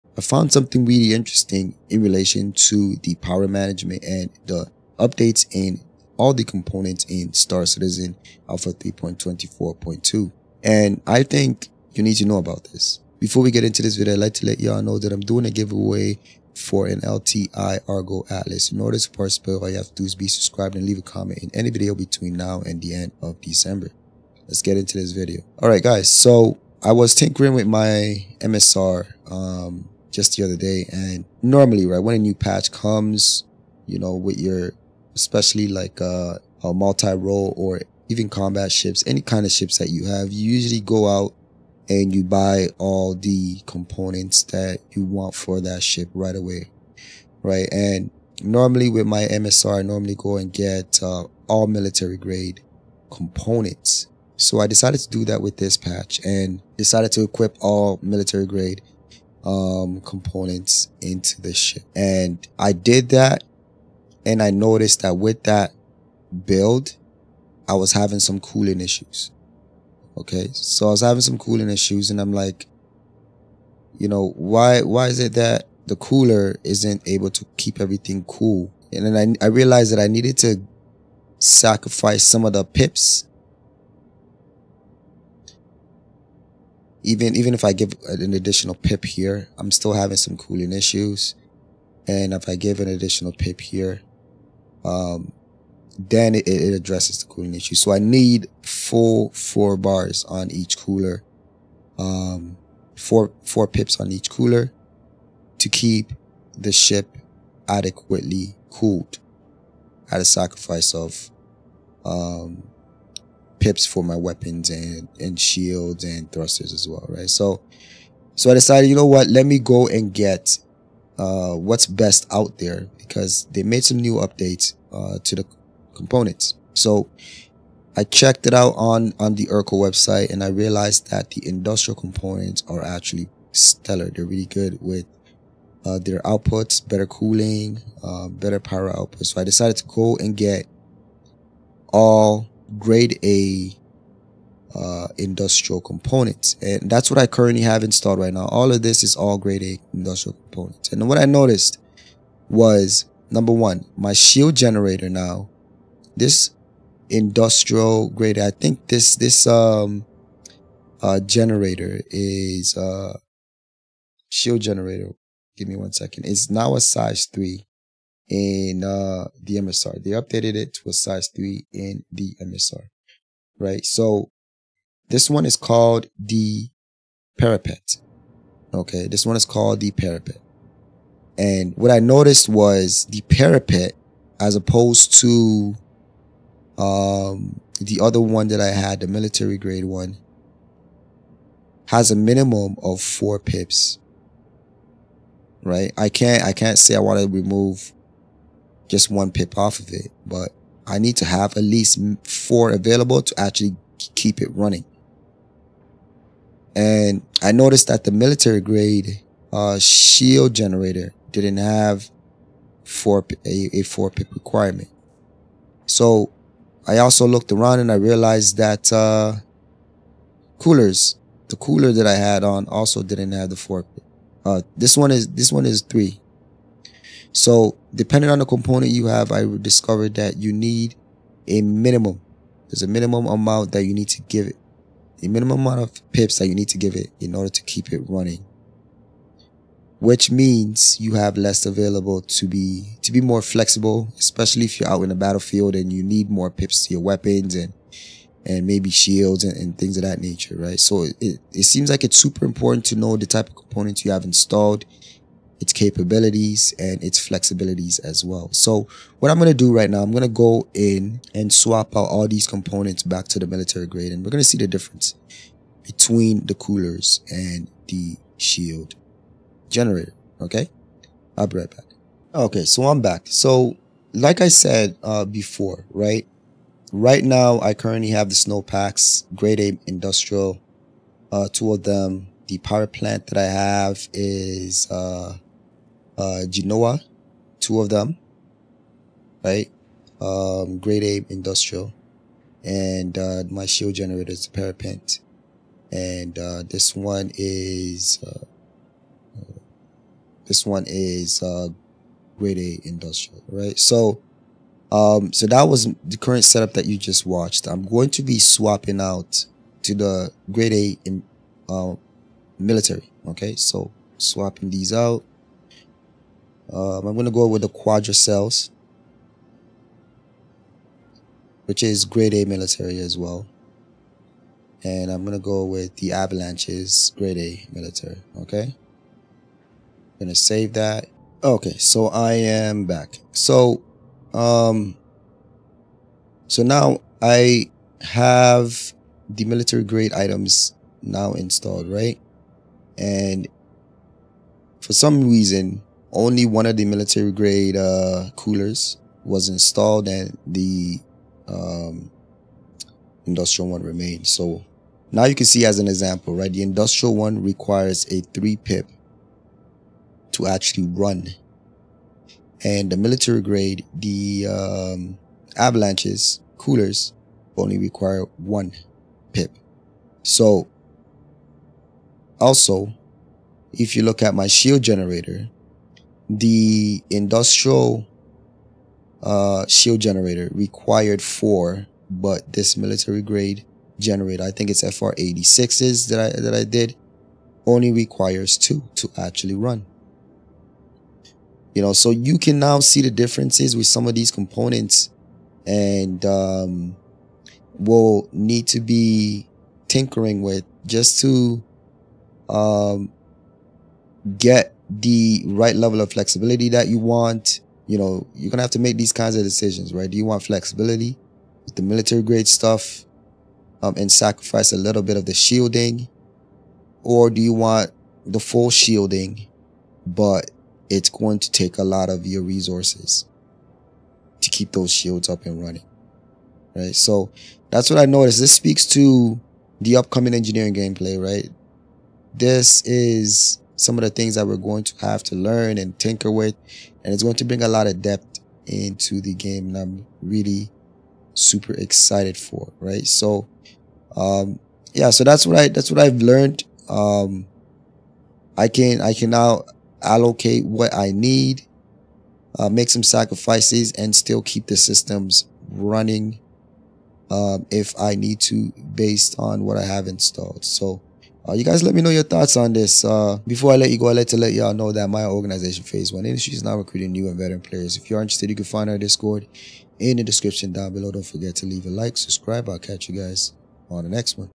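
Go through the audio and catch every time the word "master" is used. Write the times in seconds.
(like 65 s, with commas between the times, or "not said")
not said.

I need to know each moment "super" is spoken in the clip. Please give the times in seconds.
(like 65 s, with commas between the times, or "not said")
252 s, 441 s.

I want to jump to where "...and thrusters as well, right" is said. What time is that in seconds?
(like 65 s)
116 s.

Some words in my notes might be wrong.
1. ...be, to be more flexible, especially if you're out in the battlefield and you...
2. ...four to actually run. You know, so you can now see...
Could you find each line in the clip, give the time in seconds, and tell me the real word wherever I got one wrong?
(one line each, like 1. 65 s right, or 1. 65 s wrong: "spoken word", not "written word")
1. 242 s right
2. 388 s wrong: "two", not "four".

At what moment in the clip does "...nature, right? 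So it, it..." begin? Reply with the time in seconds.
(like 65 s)
250 s.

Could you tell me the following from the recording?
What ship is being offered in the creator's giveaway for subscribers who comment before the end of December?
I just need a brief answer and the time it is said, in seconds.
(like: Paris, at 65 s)
LTI Argo Atlas, at 17 s.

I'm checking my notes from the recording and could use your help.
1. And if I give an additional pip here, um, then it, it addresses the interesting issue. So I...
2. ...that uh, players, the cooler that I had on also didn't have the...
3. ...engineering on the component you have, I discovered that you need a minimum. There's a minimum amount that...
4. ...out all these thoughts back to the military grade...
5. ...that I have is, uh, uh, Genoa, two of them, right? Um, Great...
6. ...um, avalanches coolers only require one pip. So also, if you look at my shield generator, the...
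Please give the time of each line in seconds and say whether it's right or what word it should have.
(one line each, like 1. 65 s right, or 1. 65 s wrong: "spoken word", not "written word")
1. 92 s wrong: "cooling", not "interesting"
2. 218 s wrong: "coolers", not "players"
3. 227 s wrong: "depending", not "engineering"
4. 261 s wrong: "components", not "thoughts"
5. 283 s right
6. 364 s right.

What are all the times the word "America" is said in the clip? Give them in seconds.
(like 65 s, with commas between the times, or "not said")
not said.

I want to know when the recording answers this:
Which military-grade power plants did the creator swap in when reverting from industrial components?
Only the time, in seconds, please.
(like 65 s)
317 s.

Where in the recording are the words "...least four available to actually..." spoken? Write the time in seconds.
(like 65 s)
201 s.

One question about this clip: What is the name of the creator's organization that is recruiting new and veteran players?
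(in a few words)
Phase 1 Industries.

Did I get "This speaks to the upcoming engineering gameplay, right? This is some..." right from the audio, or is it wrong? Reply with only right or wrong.
right.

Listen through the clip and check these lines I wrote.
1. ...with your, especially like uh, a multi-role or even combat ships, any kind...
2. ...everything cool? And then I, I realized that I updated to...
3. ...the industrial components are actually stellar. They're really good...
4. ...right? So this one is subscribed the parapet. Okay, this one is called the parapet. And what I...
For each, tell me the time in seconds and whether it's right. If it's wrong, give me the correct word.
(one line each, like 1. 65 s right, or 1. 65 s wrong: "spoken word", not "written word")
1. 34 s right
2. 77 s wrong: "needed", not "updated"
3. 131 s right
4. 173 s wrong: "called", not "subscribed".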